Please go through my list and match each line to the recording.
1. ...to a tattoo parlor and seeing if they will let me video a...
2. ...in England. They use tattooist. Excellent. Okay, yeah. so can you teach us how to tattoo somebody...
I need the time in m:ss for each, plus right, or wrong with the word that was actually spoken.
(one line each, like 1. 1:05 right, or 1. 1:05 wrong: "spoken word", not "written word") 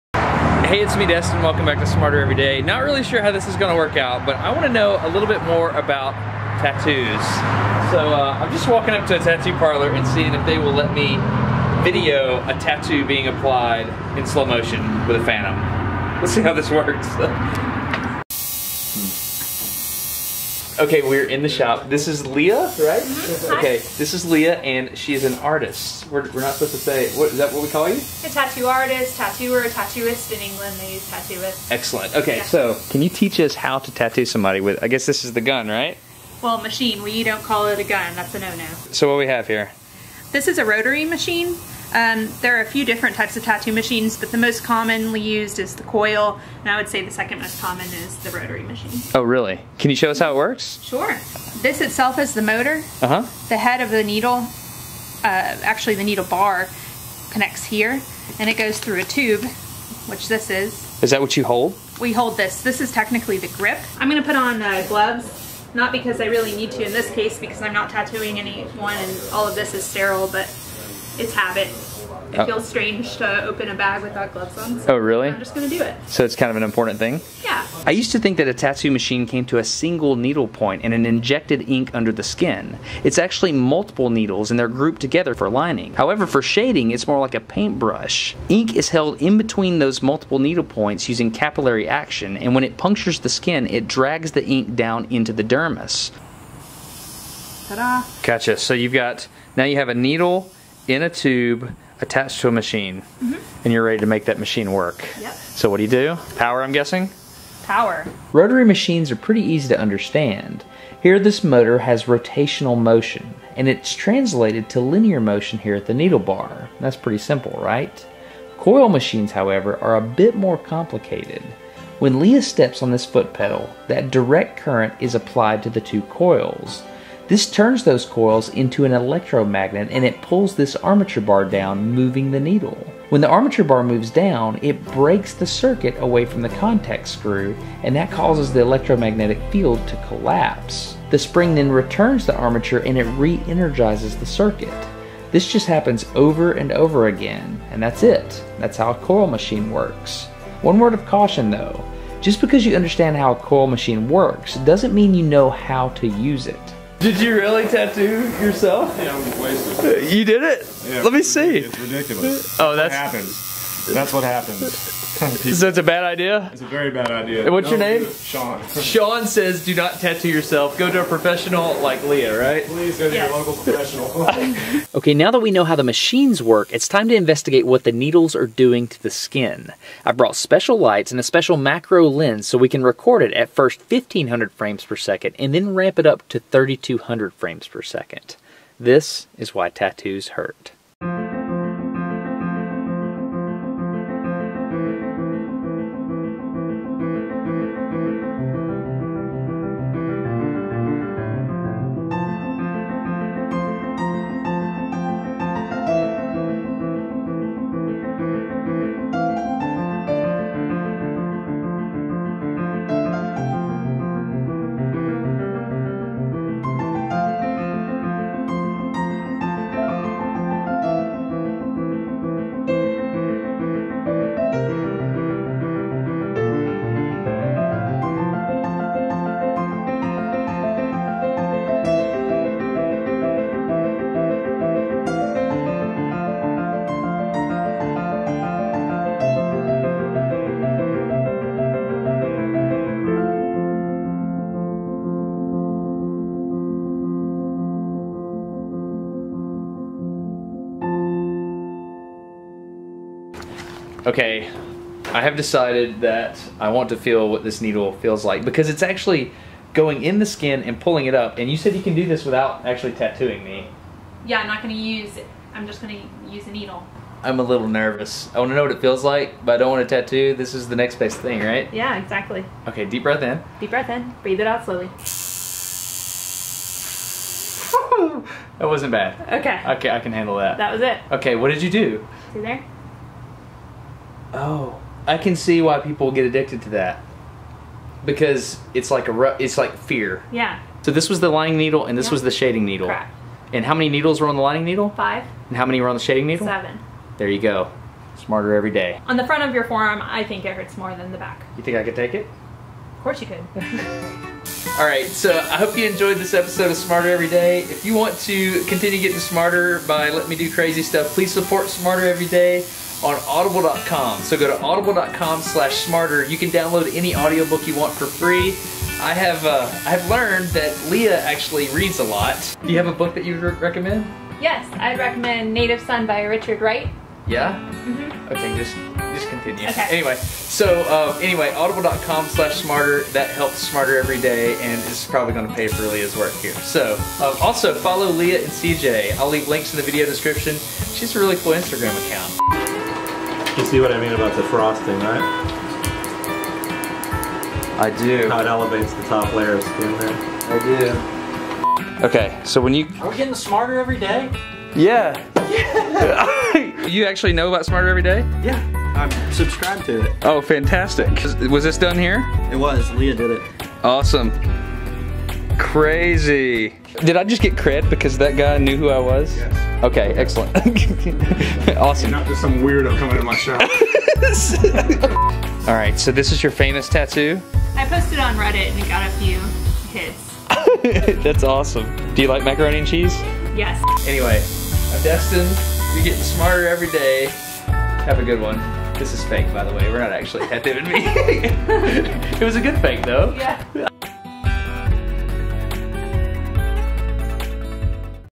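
1. 0:09 right
2. 0:30 right.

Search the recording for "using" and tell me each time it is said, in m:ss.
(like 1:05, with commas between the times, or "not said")
1:31.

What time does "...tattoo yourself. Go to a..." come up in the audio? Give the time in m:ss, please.
2:49.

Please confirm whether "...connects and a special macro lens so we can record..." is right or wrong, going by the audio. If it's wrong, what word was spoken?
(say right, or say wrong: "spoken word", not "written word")
wrong: "lights", not "connects".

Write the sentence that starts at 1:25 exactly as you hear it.
However, for shading, it's more like a paintbrush.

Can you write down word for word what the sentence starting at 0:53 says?
The head of the needle, uh, actually the needle bar, connects here, and it goes through a tube, which this is.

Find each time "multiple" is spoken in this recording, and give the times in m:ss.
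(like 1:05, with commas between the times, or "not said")
1:23, 1:30.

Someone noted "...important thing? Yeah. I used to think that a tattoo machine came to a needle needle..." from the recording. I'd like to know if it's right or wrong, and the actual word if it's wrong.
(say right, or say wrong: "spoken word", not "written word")
wrong: "single", not "needle".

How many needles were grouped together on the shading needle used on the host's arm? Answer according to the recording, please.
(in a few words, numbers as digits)
7.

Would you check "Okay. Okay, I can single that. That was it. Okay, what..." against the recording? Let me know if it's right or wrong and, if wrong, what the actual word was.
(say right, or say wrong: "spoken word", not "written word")
wrong: "handle", not "single".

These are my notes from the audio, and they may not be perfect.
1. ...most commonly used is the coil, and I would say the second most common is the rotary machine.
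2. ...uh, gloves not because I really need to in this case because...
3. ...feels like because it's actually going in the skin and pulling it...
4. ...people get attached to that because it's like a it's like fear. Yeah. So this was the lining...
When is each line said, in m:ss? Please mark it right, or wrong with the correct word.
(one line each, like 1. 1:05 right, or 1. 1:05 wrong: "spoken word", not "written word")
1. 0:44 right
2. 1:04 right
3. 4:17 right
4. 4:45 wrong: "addicted", not "attached".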